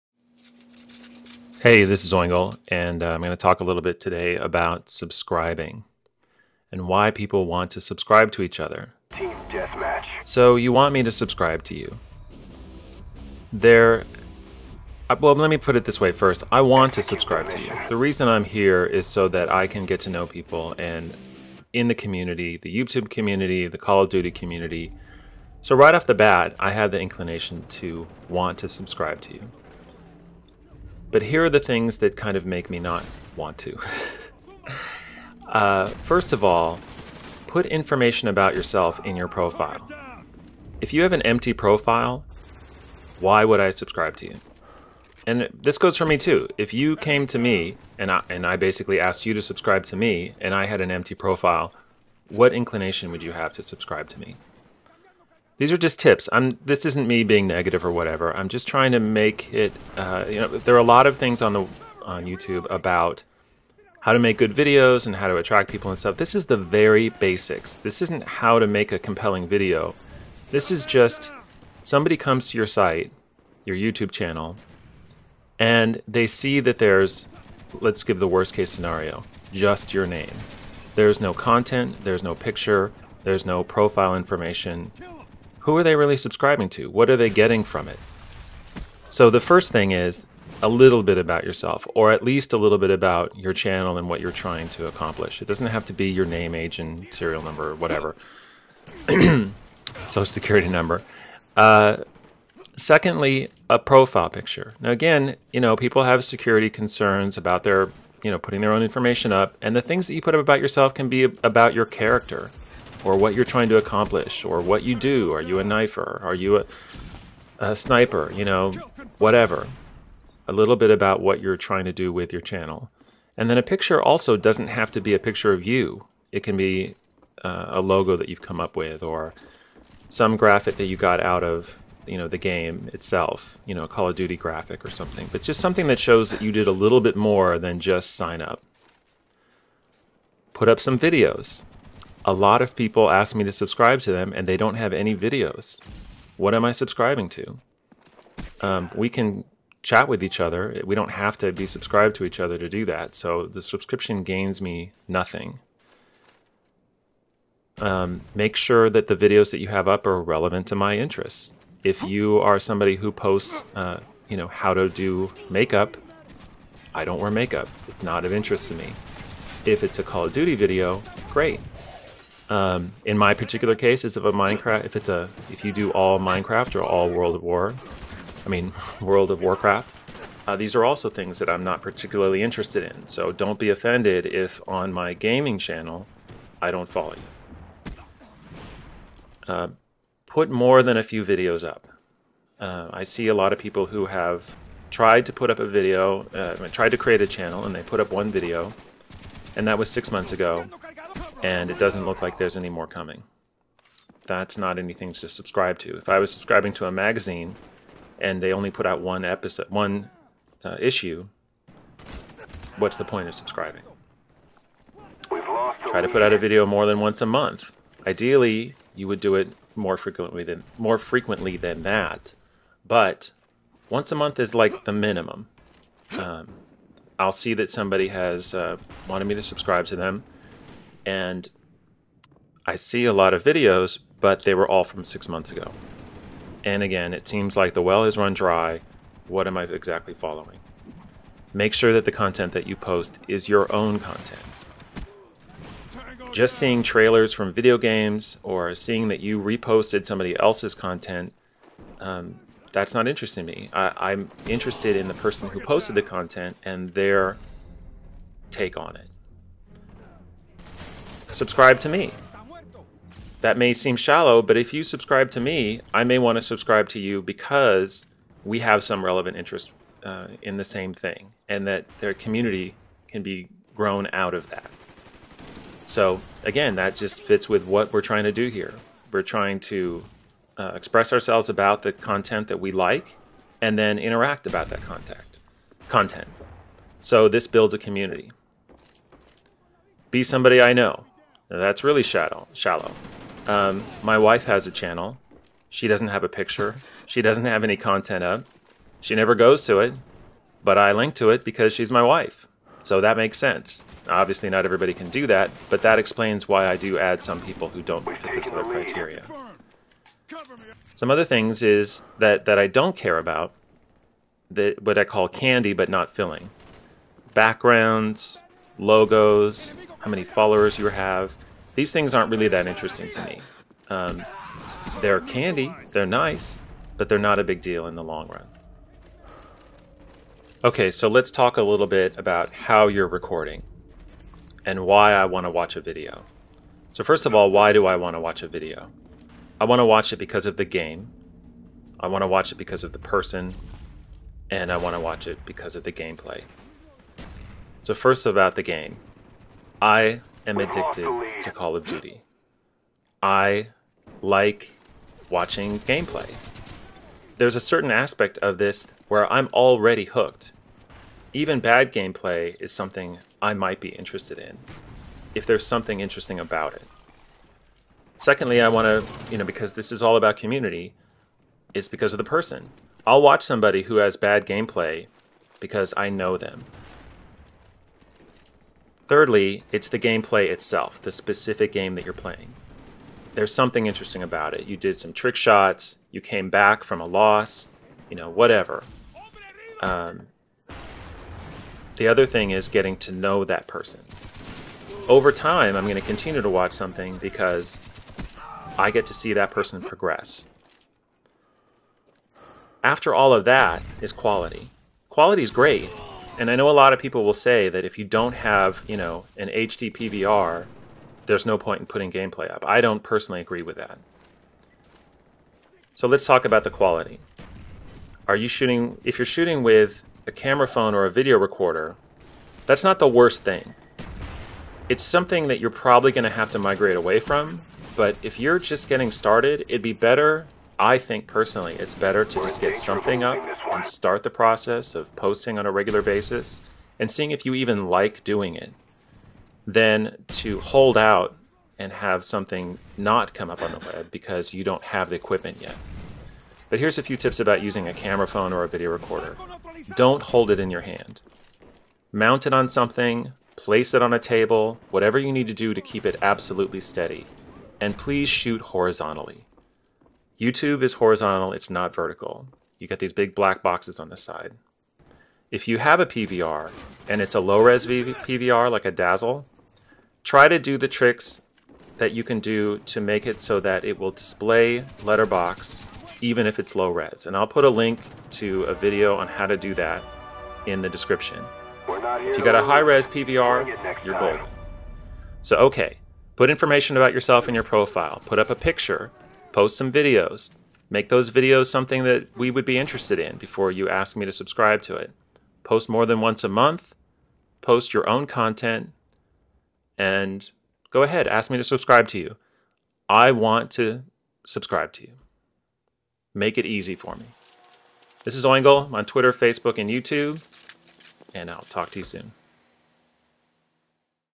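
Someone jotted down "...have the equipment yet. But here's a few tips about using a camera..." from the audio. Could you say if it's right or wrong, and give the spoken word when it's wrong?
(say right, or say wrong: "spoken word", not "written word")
right.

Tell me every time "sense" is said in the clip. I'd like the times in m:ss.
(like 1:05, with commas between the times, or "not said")
5:03.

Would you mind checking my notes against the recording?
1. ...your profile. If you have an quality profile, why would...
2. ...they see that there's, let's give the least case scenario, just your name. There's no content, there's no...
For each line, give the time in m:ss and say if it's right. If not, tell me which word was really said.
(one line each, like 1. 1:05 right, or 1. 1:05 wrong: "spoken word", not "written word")
1. 0:39 wrong: "empty", not "quality"
2. 1:16 wrong: "worst", not "least".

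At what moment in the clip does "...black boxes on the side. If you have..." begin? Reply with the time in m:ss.
7:43.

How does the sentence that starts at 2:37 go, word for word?
Um, make sure that the videos that you have up are relevant to my interests.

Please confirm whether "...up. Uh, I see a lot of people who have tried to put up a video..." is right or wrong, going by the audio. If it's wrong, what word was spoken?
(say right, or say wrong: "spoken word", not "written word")
right.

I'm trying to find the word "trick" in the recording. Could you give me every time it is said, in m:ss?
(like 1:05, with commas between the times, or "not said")
6:25, 7:50.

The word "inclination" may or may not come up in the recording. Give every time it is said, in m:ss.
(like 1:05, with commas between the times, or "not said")
0:26, 0:52.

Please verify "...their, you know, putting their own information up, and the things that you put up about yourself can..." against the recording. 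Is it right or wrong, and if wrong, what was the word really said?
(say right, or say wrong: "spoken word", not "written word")
right.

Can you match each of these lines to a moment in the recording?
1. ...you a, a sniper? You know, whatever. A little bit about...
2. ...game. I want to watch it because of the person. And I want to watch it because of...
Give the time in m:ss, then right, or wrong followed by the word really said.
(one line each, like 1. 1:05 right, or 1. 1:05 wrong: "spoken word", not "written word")
1. 1:56 right
2. 5:40 right.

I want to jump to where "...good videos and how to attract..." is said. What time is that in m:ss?
1:04.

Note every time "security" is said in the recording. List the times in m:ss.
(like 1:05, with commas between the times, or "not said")
1:40, 1:46.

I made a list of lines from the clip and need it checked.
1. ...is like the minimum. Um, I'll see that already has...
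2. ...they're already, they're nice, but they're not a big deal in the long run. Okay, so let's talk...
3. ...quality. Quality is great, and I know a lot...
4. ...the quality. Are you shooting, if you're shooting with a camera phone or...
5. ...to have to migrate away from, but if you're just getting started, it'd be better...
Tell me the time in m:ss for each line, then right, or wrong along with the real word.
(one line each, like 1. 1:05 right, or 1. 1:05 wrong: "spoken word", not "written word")
1. 3:44 wrong: "somebody", not "already"
2. 5:24 wrong: "candy", not "already"
3. 6:44 right
4. 6:56 right
5. 7:06 right.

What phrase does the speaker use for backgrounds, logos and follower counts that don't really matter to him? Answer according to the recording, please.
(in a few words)
Candy but not filling.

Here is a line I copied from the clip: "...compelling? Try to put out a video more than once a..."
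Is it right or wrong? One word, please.
wrong.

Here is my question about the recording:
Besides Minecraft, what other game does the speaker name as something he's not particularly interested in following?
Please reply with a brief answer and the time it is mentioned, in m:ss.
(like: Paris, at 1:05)
World of Warcraft, at 2:58.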